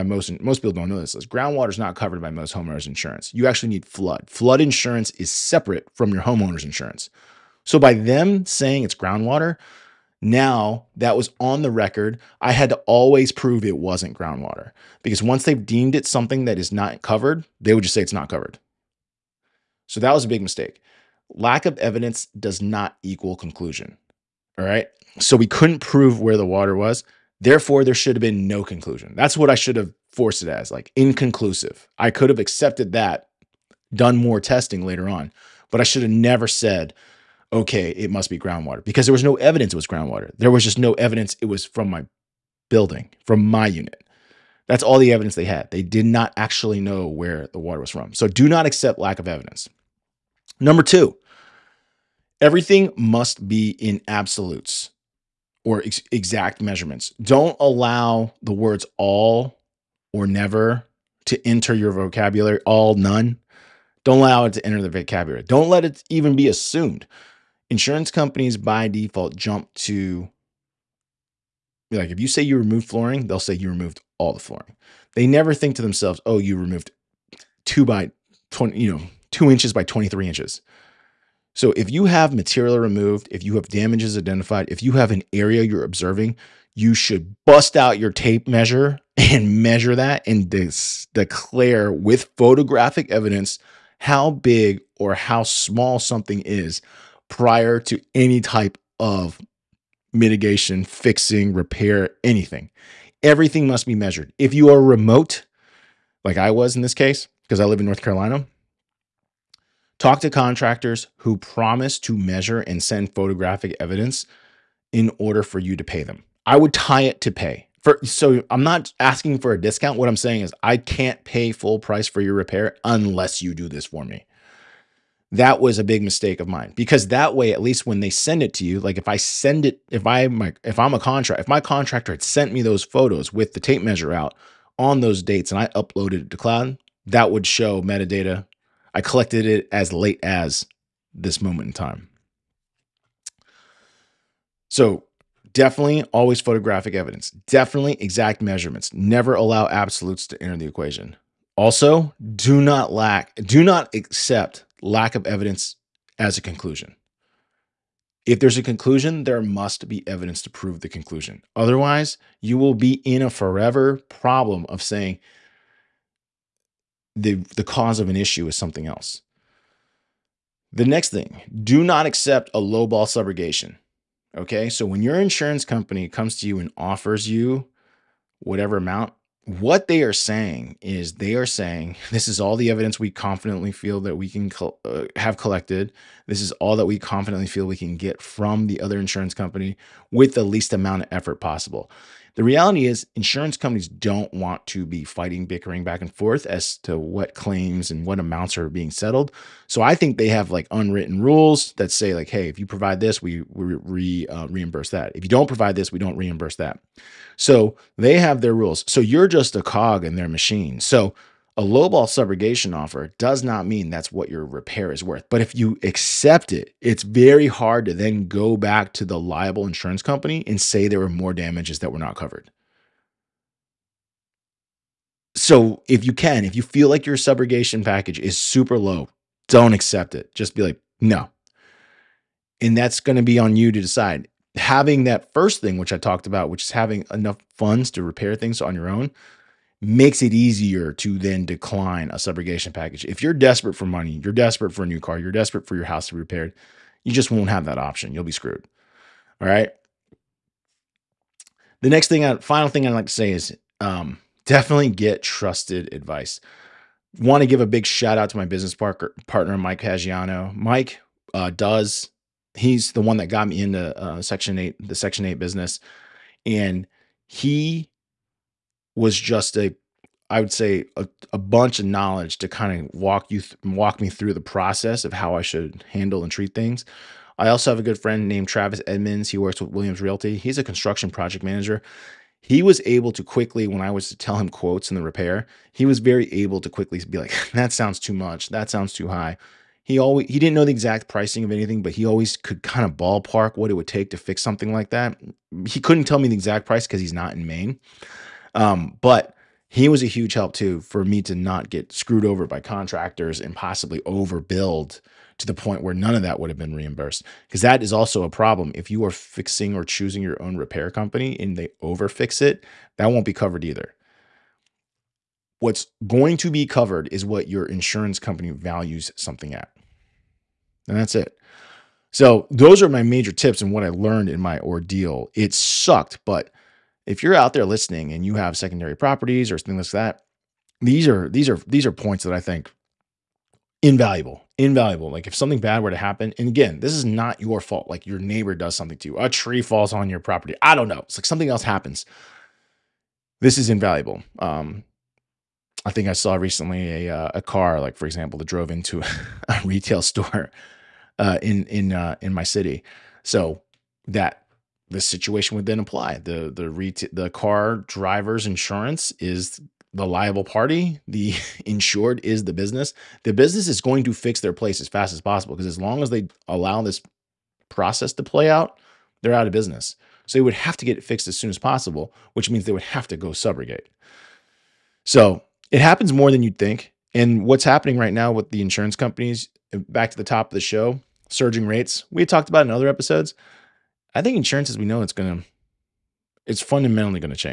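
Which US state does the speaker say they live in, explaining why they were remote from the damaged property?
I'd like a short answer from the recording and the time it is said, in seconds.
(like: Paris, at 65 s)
North Carolina, at 107 s.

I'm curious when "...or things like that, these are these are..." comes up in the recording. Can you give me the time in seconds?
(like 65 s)
329 s.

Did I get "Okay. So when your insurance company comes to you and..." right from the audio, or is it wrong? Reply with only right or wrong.
right.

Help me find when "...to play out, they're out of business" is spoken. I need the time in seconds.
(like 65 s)
368 s.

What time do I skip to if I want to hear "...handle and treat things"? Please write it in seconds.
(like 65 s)
275 s.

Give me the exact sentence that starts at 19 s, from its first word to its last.
So that was a big mistake lack of evidence does not equal conclusion.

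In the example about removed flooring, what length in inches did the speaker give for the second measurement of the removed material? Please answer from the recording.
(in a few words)
23 inches.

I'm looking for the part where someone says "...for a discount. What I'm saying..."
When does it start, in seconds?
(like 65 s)
119 s.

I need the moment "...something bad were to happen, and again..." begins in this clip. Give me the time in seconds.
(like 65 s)
335 s.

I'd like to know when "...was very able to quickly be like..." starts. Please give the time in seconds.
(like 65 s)
285 s.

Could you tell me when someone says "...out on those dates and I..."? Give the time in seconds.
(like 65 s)
134 s.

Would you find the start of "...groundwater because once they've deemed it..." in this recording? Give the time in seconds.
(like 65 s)
14 s.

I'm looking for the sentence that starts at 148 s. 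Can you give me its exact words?
Never allow absolutes to enter the equation.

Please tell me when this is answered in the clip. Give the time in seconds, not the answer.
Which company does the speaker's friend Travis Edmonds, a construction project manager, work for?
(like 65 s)
279 s.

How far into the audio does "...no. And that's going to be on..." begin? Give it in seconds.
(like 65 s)
231 s.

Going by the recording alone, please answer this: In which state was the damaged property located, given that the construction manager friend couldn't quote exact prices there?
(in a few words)
Maine.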